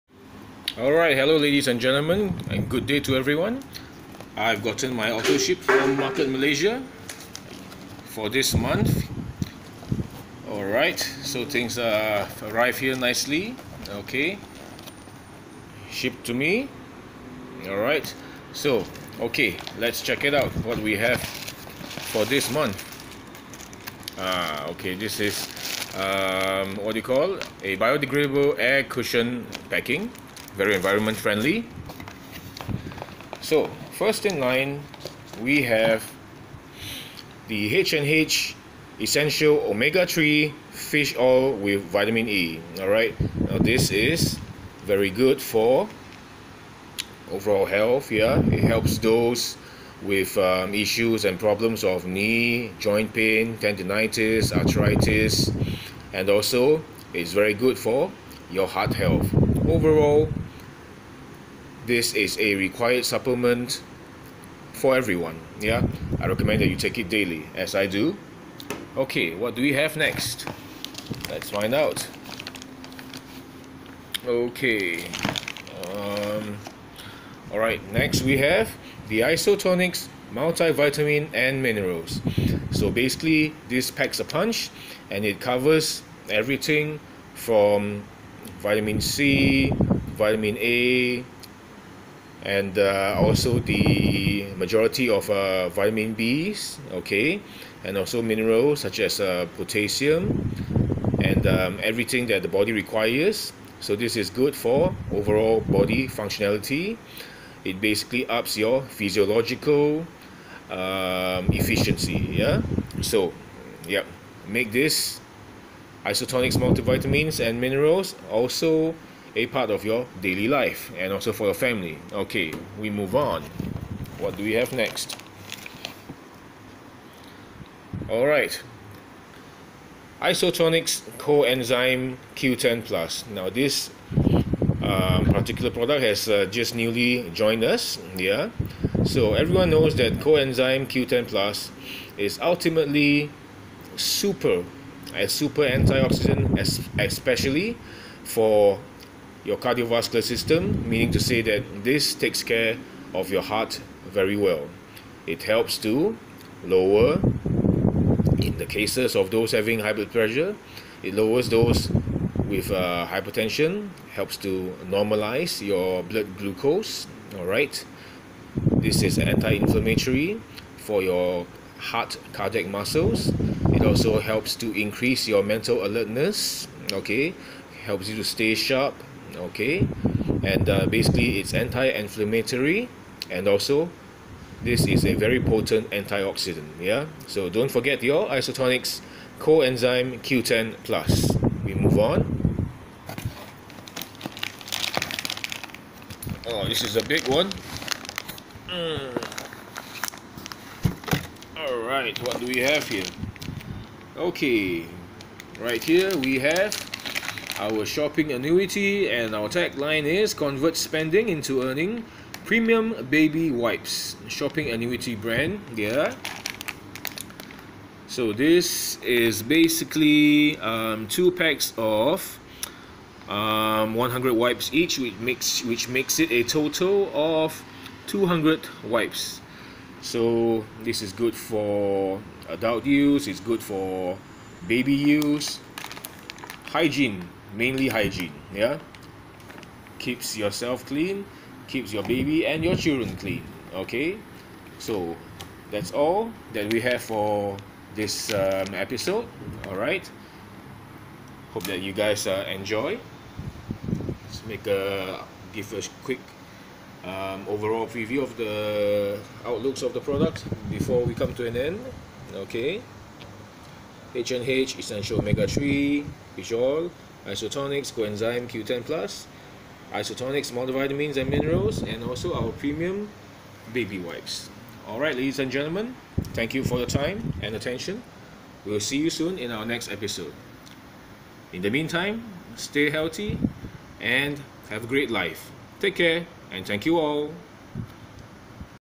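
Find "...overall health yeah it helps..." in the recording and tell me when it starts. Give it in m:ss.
0:47.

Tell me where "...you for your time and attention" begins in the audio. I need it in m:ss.
4:36.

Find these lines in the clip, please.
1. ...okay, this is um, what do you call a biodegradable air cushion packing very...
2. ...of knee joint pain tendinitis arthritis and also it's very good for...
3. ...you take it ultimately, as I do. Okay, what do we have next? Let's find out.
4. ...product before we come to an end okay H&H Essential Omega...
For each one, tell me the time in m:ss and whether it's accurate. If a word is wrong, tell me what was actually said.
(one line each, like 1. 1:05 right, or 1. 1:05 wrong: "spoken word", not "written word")
1. 0:24 right
2. 0:51 right
3. 1:06 wrong: "daily", not "ultimately"
4. 4:19 right.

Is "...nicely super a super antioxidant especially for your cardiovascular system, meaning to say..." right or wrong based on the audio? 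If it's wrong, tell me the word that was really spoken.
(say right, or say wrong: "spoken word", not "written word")
wrong: "ultimately", not "nicely".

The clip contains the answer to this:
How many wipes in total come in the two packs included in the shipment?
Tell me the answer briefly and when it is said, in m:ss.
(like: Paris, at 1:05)
200, at 3:48.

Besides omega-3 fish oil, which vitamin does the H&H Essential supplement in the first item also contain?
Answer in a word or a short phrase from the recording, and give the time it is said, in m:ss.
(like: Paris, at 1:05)
Vitamin E, at 0:41.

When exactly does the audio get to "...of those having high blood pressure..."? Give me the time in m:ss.
2:39.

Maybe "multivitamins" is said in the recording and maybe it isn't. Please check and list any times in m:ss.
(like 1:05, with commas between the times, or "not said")
1:20, 1:56, 4:30.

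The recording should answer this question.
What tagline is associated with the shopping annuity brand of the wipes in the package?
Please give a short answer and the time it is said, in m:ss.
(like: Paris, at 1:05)
Convert Spending into Earning, at 3:30.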